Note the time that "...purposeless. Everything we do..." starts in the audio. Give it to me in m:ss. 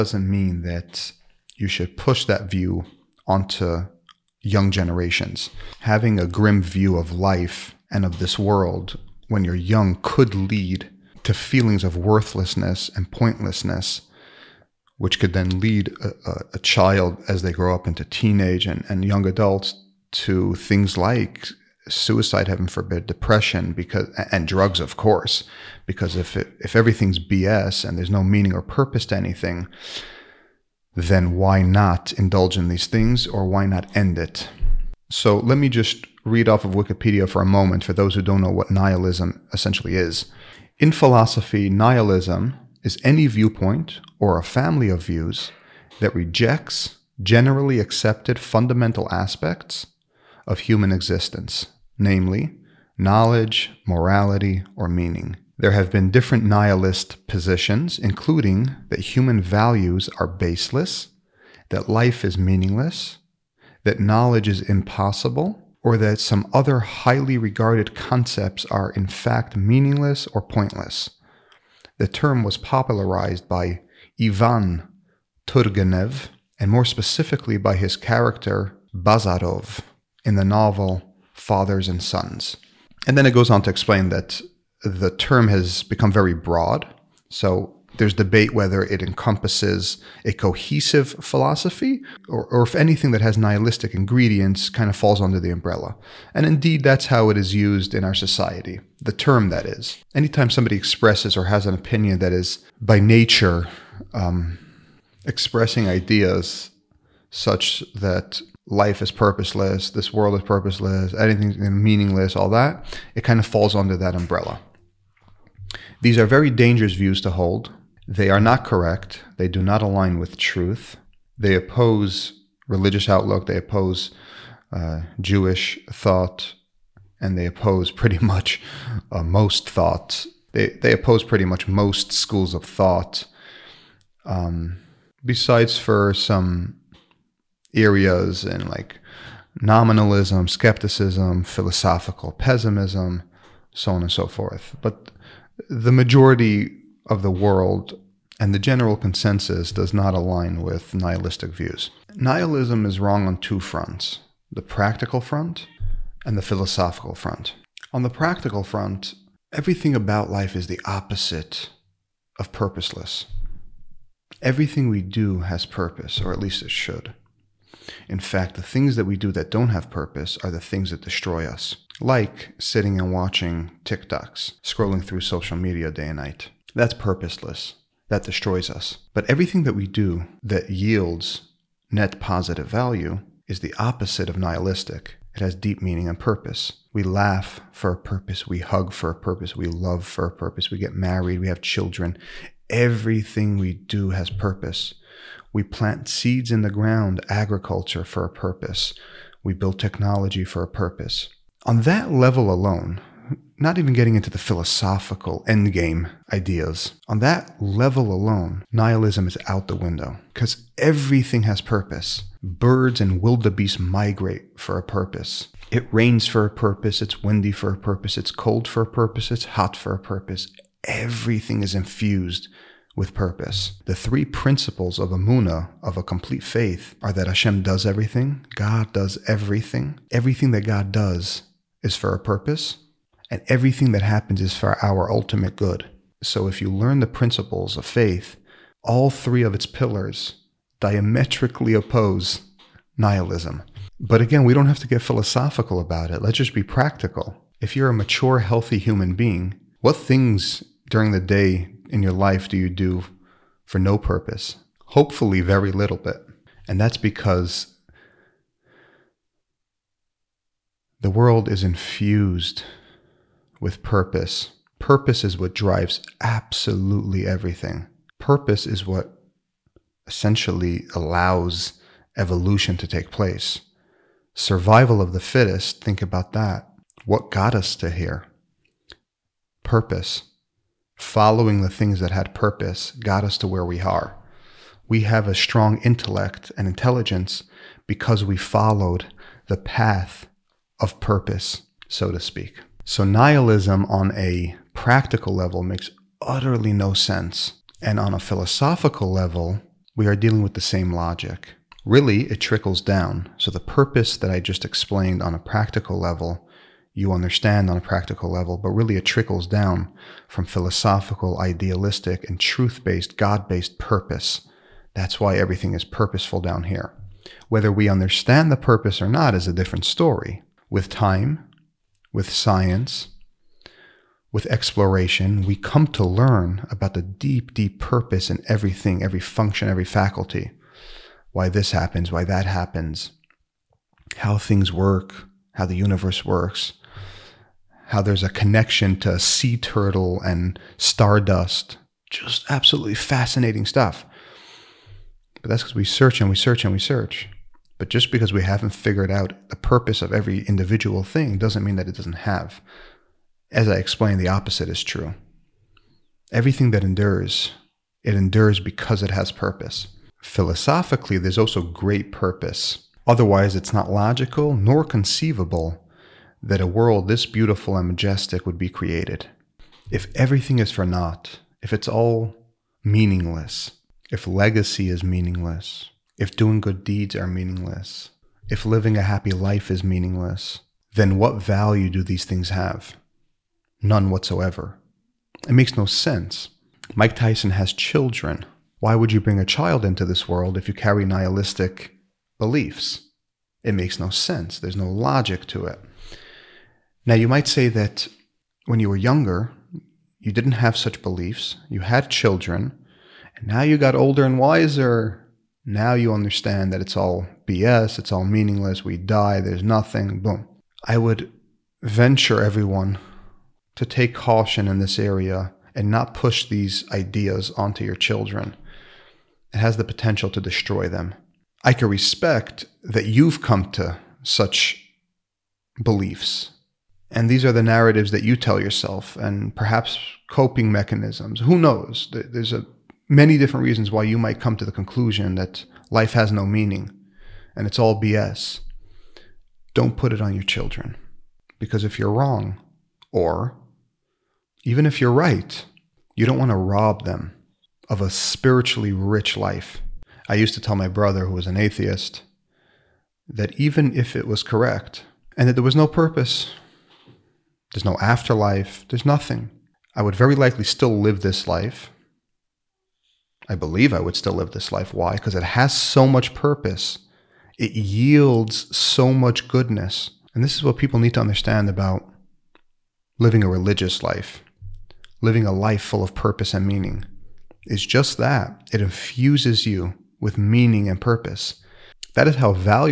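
2:42.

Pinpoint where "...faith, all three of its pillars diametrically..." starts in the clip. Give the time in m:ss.
3:57.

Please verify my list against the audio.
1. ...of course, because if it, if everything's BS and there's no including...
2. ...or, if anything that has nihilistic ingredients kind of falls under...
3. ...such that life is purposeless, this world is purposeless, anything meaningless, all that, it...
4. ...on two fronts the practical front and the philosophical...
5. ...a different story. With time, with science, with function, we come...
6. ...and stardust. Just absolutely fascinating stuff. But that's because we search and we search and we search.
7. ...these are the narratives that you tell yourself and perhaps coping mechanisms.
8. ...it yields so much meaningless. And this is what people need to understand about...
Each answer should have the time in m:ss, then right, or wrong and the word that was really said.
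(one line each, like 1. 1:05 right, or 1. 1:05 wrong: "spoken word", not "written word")
1. 0:24 wrong: "meaning", not "including"
2. 1:32 right
3. 1:47 right
4. 2:33 right
5. 5:19 wrong: "exploration", not "function"
6. 5:40 right
7. 7:07 right
8. 7:47 wrong: "goodness", not "meaningless".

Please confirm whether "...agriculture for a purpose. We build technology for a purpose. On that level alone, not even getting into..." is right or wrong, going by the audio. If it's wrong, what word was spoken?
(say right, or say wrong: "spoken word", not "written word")
right.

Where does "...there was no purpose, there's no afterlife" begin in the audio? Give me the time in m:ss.
7:35.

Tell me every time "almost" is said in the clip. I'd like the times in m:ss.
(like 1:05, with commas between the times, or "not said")
not said.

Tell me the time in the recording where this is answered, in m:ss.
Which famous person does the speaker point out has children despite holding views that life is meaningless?
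6:26.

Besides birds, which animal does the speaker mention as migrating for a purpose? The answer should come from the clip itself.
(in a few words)
Wildebeest.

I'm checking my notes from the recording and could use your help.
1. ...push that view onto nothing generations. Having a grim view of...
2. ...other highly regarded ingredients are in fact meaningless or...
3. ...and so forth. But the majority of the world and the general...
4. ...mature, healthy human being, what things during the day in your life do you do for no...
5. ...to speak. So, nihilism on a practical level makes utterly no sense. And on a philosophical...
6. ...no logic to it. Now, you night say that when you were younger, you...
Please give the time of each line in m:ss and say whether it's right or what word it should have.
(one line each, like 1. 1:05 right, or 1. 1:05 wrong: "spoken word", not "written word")
1. 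0:01 wrong: "young", not "nothing"
2. 1:06 wrong: "concepts", not "ingredients"
3. 2:24 right
4. 4:07 right
5. 4:52 right
6. 6:34 wrong: "might", not "night".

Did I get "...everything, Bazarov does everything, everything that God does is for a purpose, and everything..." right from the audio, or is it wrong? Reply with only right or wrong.
wrong.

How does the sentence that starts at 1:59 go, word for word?
They do not align with truth.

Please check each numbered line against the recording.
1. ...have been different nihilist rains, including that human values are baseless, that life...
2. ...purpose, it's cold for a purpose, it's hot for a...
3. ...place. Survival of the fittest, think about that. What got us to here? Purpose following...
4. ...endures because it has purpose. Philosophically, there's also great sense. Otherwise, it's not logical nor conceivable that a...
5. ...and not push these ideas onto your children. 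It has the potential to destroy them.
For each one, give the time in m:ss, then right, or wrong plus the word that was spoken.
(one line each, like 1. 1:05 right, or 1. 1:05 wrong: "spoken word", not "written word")
1. 0:55 wrong: "positions", not "rains"
2. 3:37 right
3. 4:33 right
4. 5:58 wrong: "purpose", not "sense"
5. 6:55 right.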